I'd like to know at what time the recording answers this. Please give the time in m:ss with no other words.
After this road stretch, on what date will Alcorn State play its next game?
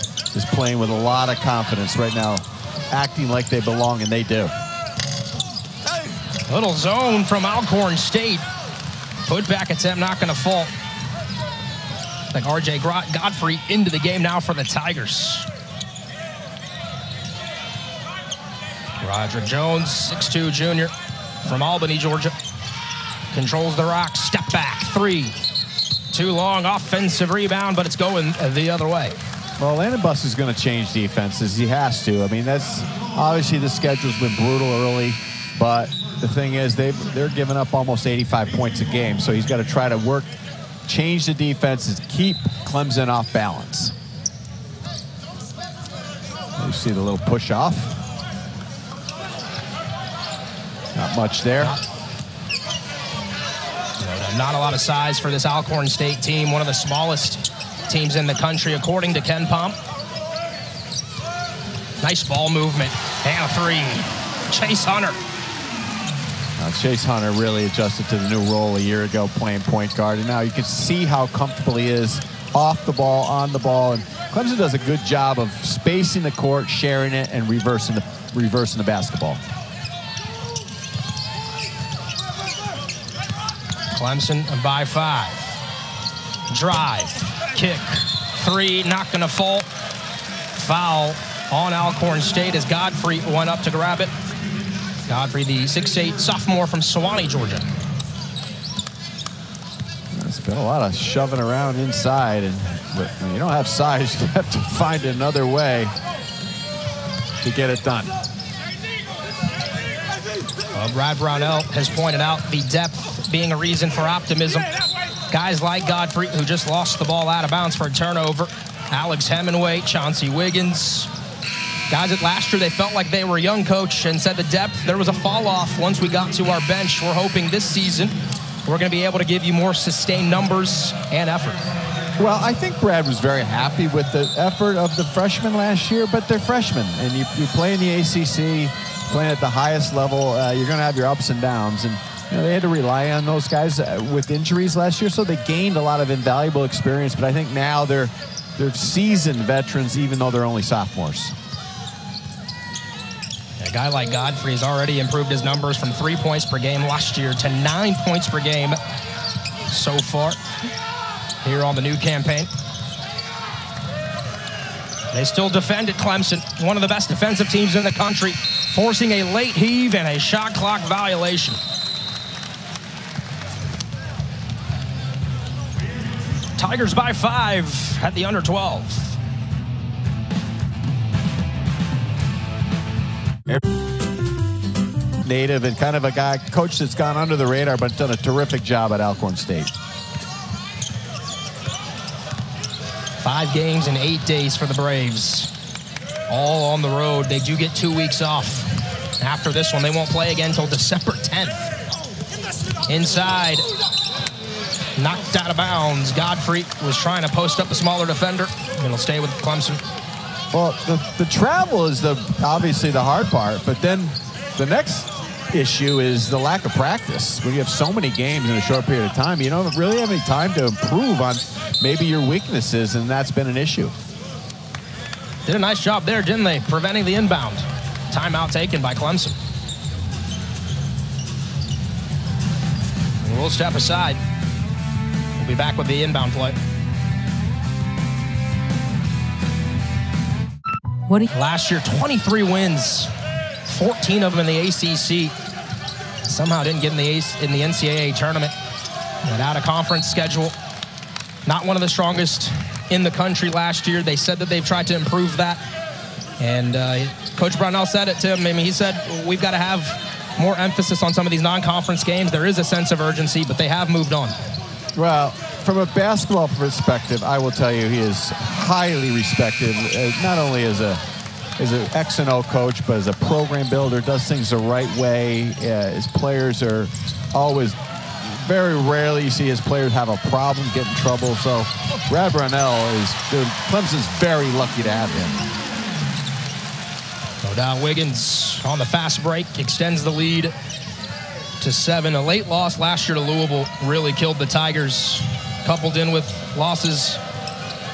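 3:20.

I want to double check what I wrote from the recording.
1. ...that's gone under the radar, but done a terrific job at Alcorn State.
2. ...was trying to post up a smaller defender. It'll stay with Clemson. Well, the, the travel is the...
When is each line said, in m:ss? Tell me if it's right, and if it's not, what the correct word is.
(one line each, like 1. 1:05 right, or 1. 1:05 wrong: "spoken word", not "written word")
1. 3:06 right
2. 3:26 right.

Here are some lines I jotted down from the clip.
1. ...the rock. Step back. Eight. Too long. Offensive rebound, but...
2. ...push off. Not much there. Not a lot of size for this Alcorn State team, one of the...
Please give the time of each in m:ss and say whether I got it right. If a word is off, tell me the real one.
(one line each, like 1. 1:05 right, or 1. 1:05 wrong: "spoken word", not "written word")
1. 0:23 wrong: "Three", not "Eight"
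2. 0:47 right.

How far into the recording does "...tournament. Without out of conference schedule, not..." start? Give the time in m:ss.
4:08.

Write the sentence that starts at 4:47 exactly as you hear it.
Don uh, Wiggins on the fast break extends the lead to seven.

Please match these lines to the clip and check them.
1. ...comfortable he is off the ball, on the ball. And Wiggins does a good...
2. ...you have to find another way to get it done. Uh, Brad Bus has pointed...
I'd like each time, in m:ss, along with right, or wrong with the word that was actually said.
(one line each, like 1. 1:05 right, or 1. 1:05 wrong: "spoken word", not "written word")
1. 1:11 wrong: "Clemson", not "Wiggins"
2. 1:44 wrong: "Brownell", not "Bus".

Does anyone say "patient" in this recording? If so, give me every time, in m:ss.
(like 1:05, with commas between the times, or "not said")
not said.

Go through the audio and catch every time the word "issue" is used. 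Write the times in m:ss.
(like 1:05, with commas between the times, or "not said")
3:35, 3:43.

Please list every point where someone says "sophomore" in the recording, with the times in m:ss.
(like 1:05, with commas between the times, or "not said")
1:36, 2:30.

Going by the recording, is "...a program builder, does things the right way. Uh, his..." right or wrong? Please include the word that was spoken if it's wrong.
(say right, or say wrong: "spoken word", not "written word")
right.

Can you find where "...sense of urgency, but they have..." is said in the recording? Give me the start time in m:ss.
4:22.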